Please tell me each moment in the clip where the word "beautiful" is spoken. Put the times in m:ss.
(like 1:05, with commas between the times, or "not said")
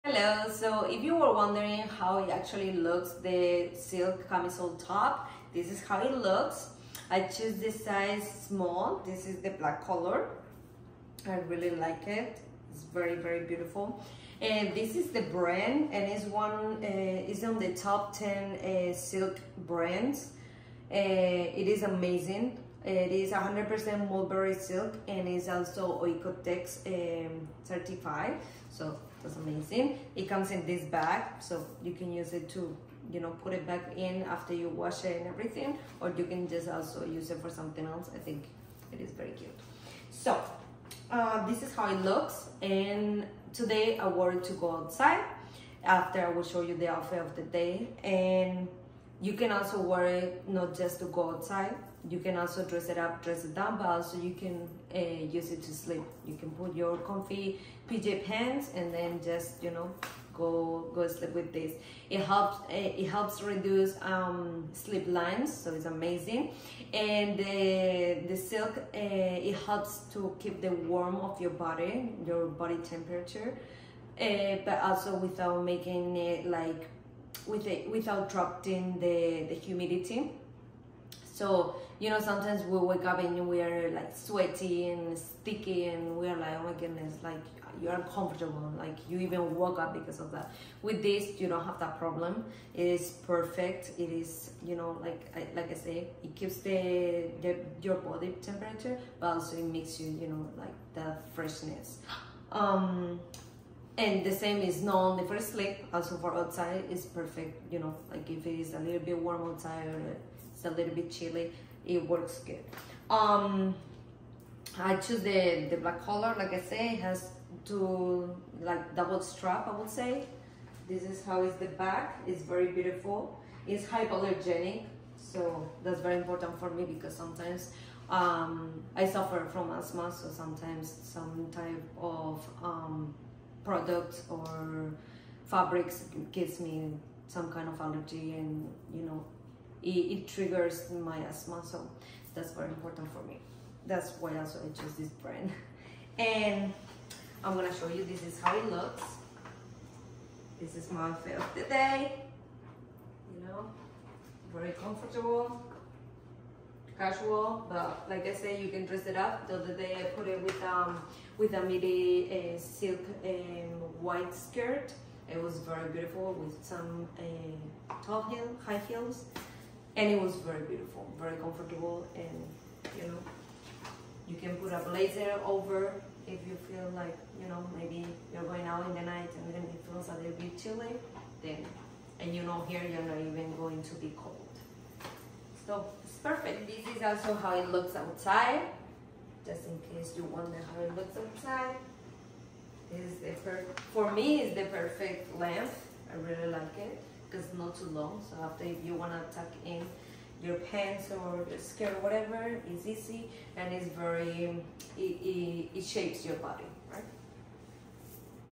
0:13, 2:02, 2:45, 2:50.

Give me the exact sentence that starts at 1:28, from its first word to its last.
Like you even woke up because of that.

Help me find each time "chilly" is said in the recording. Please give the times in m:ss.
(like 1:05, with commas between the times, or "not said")
1:51, 3:00.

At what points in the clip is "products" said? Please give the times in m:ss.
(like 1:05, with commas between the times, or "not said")
2:13.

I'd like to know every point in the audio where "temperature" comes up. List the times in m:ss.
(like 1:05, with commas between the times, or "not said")
1:12, 1:38.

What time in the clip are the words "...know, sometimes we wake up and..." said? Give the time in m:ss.
1:22.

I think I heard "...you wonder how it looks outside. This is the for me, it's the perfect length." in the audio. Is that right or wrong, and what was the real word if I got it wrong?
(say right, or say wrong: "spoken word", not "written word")
right.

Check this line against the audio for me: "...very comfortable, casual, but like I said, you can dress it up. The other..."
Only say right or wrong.
right.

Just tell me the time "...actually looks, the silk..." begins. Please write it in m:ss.
0:02.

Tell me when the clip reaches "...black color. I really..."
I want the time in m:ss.
0:09.